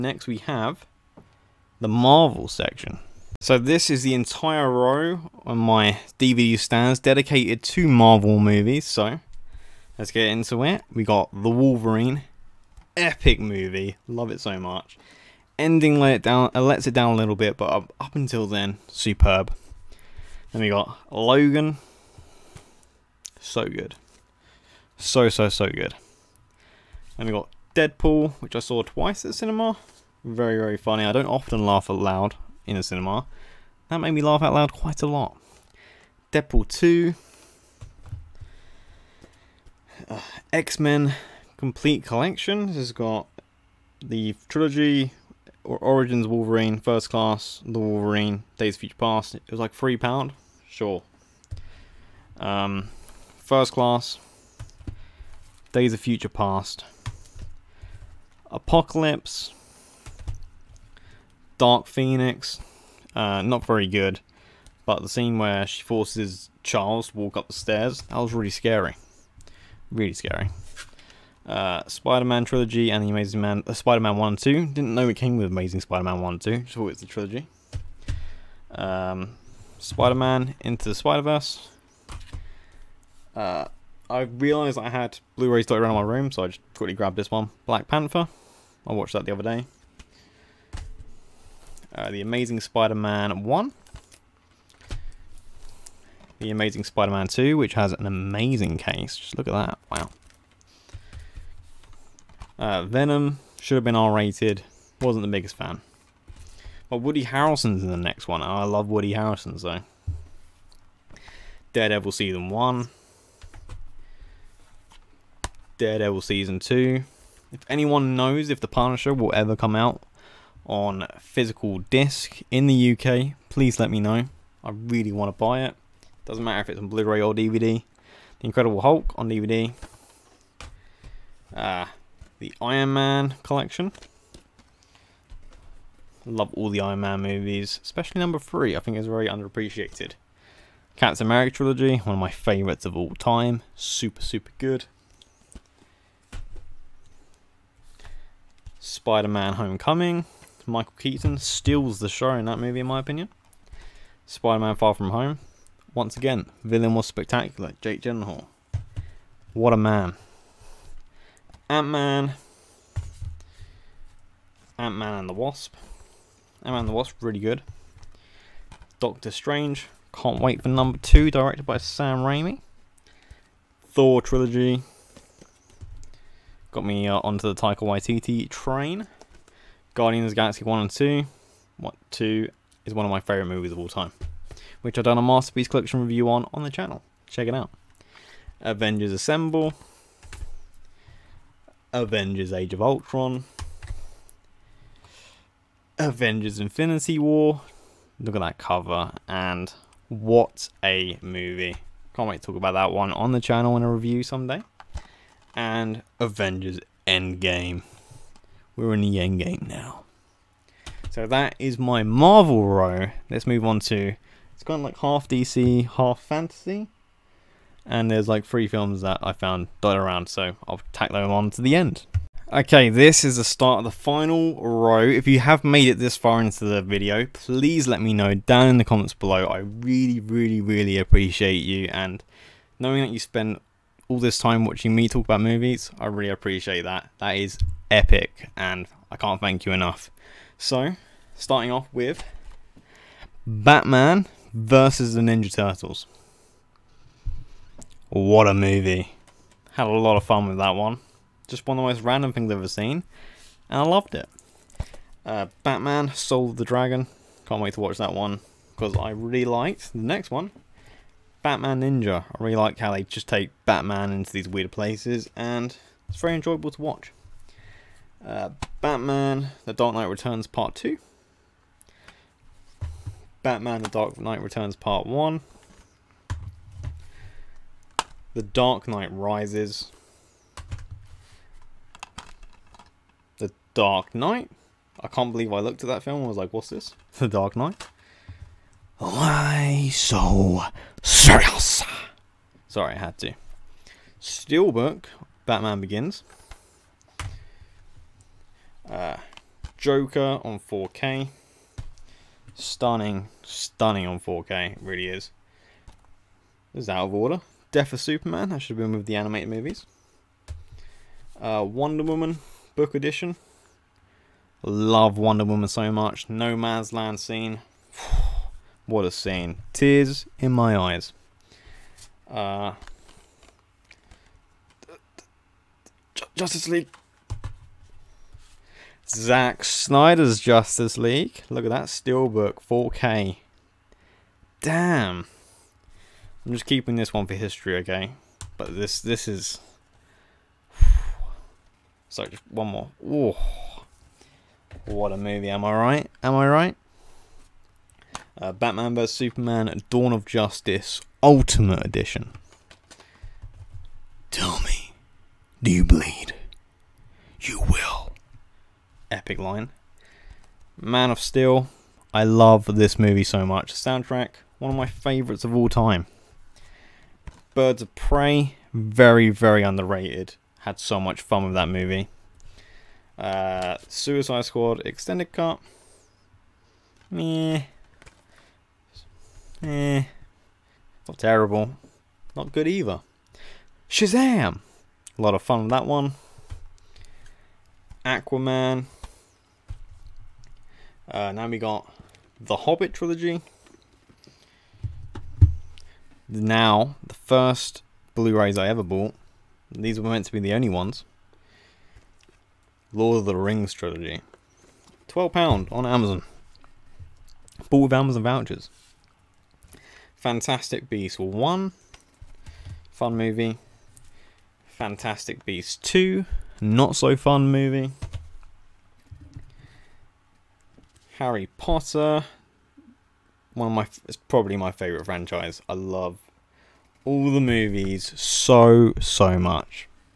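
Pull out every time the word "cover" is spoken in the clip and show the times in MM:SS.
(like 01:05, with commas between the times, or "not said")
03:18.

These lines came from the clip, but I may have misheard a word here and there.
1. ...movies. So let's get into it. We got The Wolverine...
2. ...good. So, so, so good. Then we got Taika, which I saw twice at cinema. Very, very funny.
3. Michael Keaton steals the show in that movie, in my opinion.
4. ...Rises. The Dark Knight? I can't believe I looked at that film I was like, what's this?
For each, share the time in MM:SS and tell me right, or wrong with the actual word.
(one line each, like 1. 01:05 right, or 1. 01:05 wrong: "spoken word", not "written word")
1. 00:08 right
2. 00:23 wrong: "Deadpool", not "Taika"
3. 02:30 right
4. 04:39 right.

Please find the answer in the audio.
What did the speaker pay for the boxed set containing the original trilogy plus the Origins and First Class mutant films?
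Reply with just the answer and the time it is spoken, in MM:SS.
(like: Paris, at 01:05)
£3, at 00:49.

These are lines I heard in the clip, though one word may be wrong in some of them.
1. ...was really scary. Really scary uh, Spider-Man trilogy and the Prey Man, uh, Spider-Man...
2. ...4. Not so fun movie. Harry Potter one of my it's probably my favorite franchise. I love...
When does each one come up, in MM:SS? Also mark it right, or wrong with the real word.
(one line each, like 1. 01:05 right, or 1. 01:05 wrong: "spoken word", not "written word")
1. 01:08 wrong: "Amazing", not "Prey"
2. 06:55 wrong: "2", not "4".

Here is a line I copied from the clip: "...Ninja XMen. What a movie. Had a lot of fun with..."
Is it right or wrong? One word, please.
wrong.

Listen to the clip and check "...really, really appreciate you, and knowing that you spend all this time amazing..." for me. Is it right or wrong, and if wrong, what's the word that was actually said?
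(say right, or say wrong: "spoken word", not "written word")
wrong: "watching", not "amazing".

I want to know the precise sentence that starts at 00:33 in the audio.
That made me laugh out loud quite a lot.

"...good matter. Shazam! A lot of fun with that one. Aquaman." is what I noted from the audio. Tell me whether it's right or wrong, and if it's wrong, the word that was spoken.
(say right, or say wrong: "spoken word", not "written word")
wrong: "either", not "matter".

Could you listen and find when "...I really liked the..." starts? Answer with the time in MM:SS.
04:18.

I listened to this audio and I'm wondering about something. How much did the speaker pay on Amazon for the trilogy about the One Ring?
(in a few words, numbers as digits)
£12.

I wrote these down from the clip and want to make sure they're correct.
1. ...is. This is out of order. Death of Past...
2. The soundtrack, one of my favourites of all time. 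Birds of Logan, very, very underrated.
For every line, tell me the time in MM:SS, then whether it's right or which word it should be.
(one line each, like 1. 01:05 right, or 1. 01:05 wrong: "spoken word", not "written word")
1. 05:05 wrong: "Superman", not "Past"
2. 06:03 wrong: "Prey", not "Logan".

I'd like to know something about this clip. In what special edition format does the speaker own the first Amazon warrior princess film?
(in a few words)
Book edition.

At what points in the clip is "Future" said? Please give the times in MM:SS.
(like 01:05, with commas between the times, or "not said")
00:48, 00:55.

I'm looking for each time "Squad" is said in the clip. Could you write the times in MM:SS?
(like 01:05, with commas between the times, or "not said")
06:14.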